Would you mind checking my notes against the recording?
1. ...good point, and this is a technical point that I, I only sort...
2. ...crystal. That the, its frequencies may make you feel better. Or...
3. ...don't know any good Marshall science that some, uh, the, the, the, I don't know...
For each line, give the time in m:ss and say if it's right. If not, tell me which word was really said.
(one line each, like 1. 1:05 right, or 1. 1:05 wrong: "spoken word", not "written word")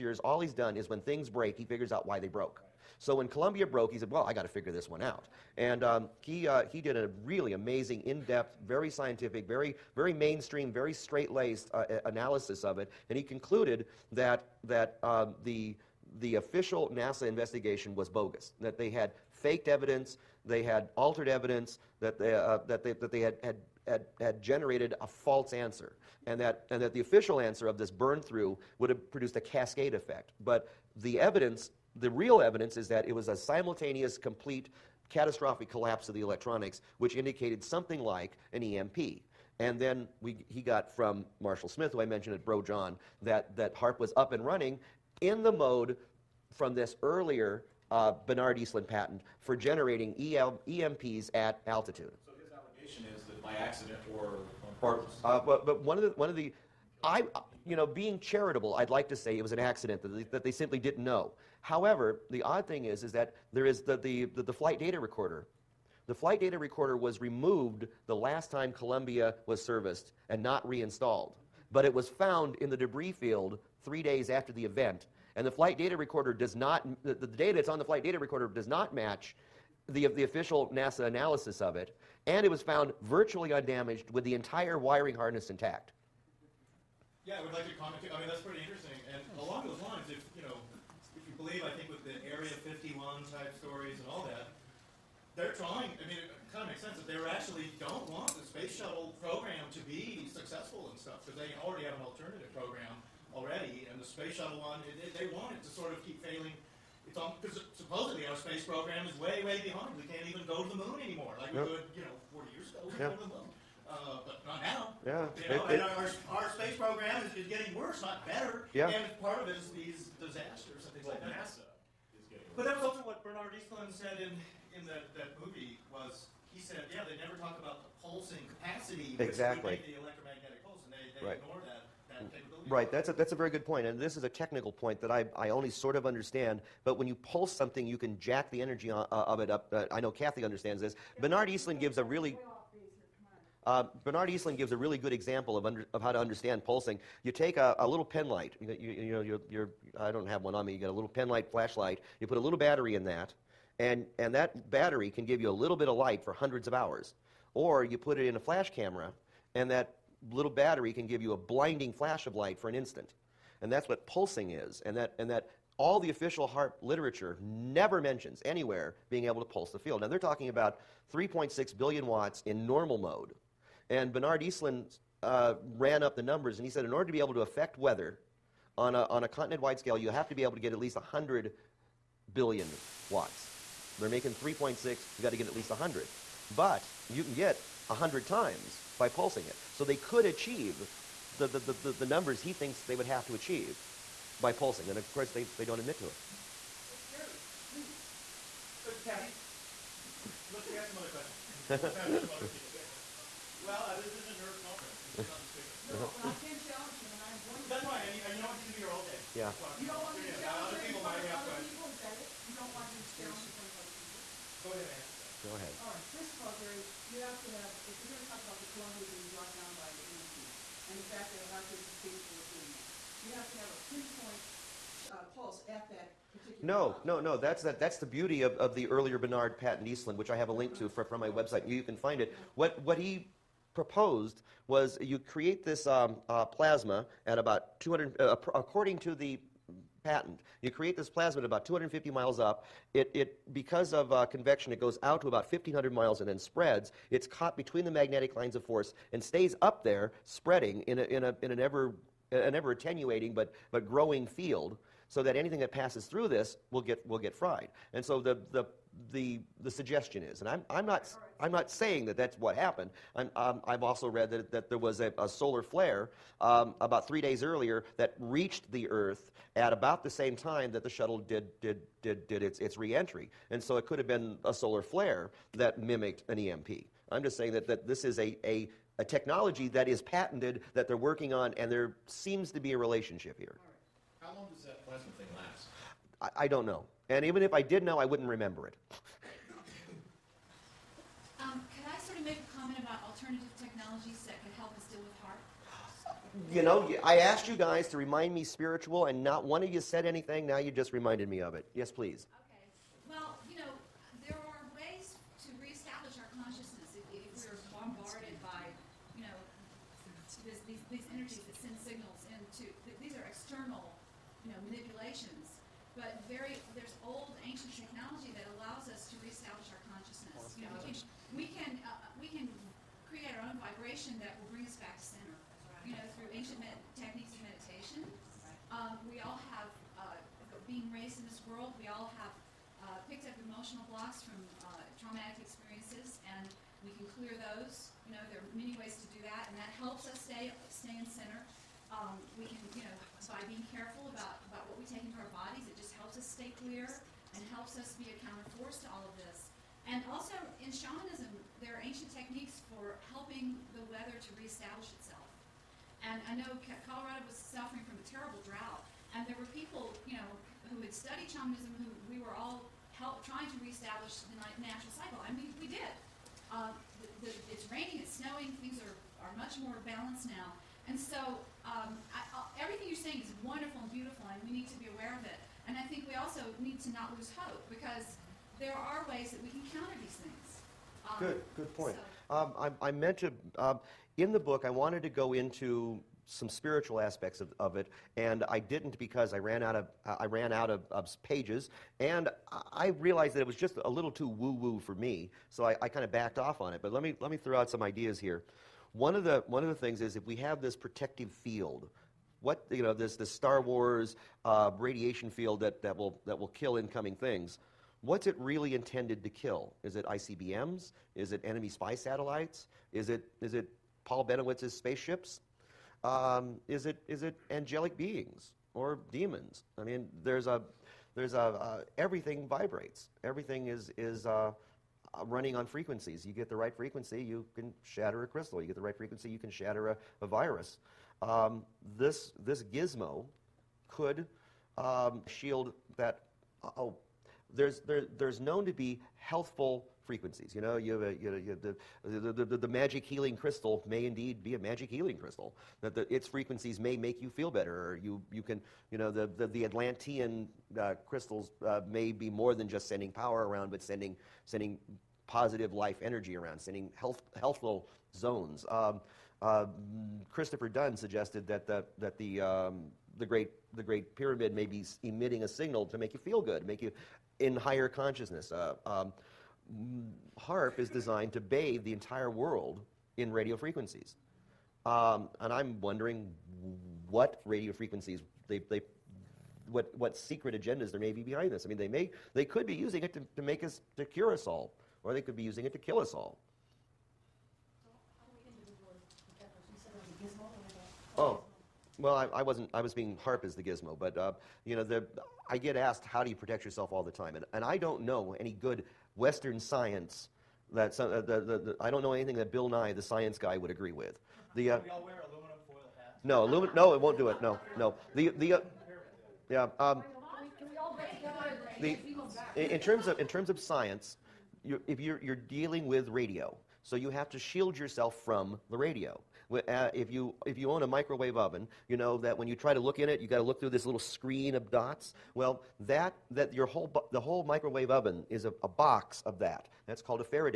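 1. 2:13 right
2. 7:25 right
3. 8:17 wrong: "Western", not "Marshall".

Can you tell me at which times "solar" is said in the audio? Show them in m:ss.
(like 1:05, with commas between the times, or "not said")
4:25, 4:34.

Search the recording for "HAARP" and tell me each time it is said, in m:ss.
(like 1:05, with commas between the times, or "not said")
0:43, 2:46, 4:55, 7:50, 8:13.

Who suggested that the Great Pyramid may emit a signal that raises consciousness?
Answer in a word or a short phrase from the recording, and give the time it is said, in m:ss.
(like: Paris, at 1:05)
Christopher Dunn, at 7:40.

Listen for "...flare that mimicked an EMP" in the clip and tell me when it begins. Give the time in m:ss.
4:34.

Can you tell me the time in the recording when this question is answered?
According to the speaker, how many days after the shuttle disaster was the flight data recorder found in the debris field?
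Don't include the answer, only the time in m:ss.
1:13.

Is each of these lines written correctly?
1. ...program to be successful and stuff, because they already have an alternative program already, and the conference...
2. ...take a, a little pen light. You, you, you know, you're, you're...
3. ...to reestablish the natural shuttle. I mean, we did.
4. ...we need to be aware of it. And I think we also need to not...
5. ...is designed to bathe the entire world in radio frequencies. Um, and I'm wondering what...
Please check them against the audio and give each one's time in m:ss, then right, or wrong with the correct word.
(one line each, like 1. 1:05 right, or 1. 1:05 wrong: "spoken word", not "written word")
1. 1:39 wrong: "space", not "conference"
2. 2:27 right
3. 6:03 wrong: "cycle", not "shuttle"
4. 6:14 right
5. 7:50 right.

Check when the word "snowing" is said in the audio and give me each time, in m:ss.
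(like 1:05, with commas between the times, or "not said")
6:08.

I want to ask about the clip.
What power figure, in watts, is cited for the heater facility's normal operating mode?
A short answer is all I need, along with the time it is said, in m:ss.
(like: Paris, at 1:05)
3.6 billion watts, at 2:51.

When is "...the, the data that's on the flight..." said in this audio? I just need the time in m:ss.
1:17.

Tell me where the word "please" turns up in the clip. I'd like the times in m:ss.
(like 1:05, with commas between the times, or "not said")
3:17, 5:01.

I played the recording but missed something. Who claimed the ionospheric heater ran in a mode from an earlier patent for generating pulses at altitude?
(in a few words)
Marshall Smith.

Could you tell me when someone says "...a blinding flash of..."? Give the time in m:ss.
2:41.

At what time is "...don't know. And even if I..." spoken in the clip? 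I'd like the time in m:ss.
4:46.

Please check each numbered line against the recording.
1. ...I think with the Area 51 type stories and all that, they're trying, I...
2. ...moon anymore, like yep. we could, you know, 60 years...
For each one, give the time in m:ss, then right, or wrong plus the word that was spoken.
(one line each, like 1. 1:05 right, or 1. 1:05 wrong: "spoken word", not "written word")
1. 1:31 right
2. 1:50 wrong: "40", not "60".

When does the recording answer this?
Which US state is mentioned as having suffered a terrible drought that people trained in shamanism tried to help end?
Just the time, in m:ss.
5:56.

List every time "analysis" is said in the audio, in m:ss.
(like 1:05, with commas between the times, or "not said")
0:12, 1:21.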